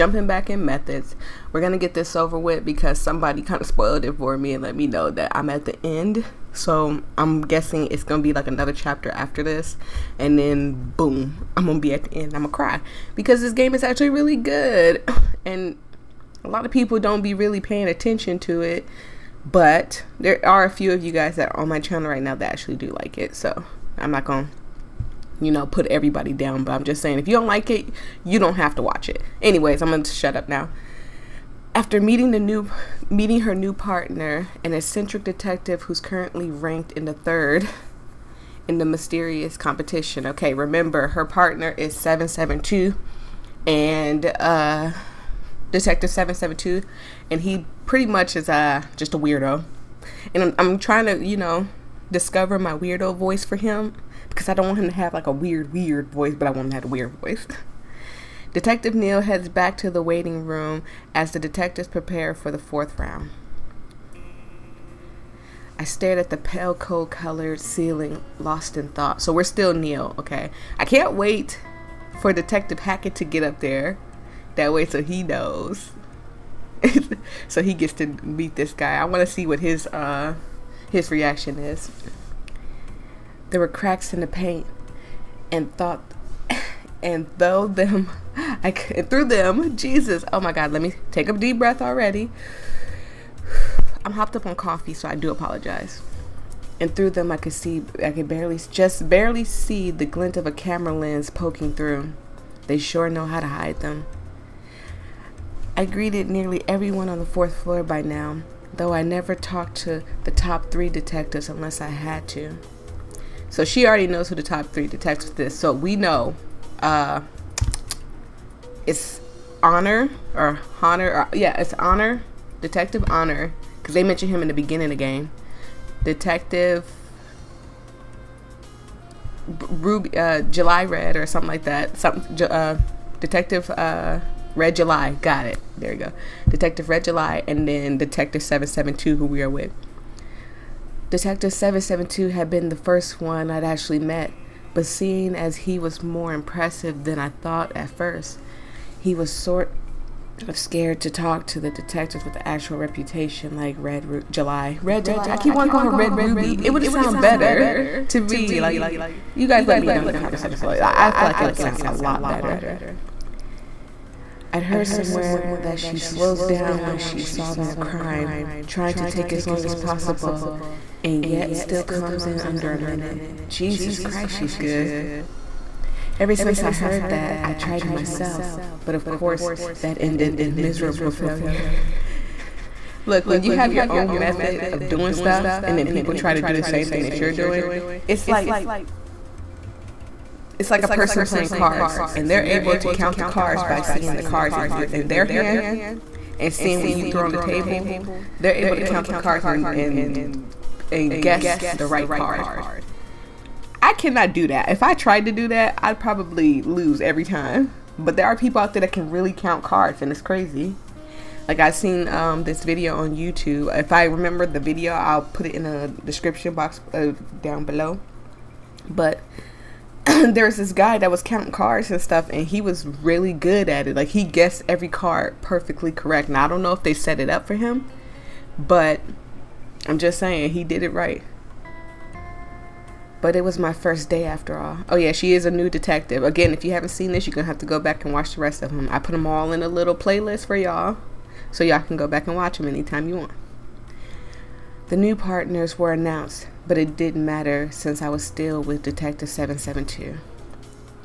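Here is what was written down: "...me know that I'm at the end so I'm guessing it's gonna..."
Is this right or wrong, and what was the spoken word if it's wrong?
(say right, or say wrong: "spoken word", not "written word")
right.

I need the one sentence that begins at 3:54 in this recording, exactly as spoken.
Oh yeah, she is a new detective.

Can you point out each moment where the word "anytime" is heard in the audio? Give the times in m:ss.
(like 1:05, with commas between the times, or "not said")
4:02.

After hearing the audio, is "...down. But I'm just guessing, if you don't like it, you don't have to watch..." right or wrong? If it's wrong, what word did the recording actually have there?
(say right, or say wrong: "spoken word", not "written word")
wrong: "saying", not "guessing".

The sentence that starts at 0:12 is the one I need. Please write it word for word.
I'm gonna cry because this game is actually really good, and a lot of people don't be really paying attention to it.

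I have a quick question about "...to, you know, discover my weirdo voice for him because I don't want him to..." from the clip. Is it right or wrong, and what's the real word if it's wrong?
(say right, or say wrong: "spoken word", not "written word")
right.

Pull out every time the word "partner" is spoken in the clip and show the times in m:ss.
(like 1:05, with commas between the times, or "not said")
0:33, 0:41, 4:05.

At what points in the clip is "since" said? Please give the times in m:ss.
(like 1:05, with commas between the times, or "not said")
2:56, 4:07.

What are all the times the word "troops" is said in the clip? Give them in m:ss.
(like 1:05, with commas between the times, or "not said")
not said.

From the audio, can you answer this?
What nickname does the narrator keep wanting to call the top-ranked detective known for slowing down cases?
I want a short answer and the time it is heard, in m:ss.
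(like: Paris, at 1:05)
Red Ruby, at 2:35.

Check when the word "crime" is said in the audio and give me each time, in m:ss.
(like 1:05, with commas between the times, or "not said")
2:47.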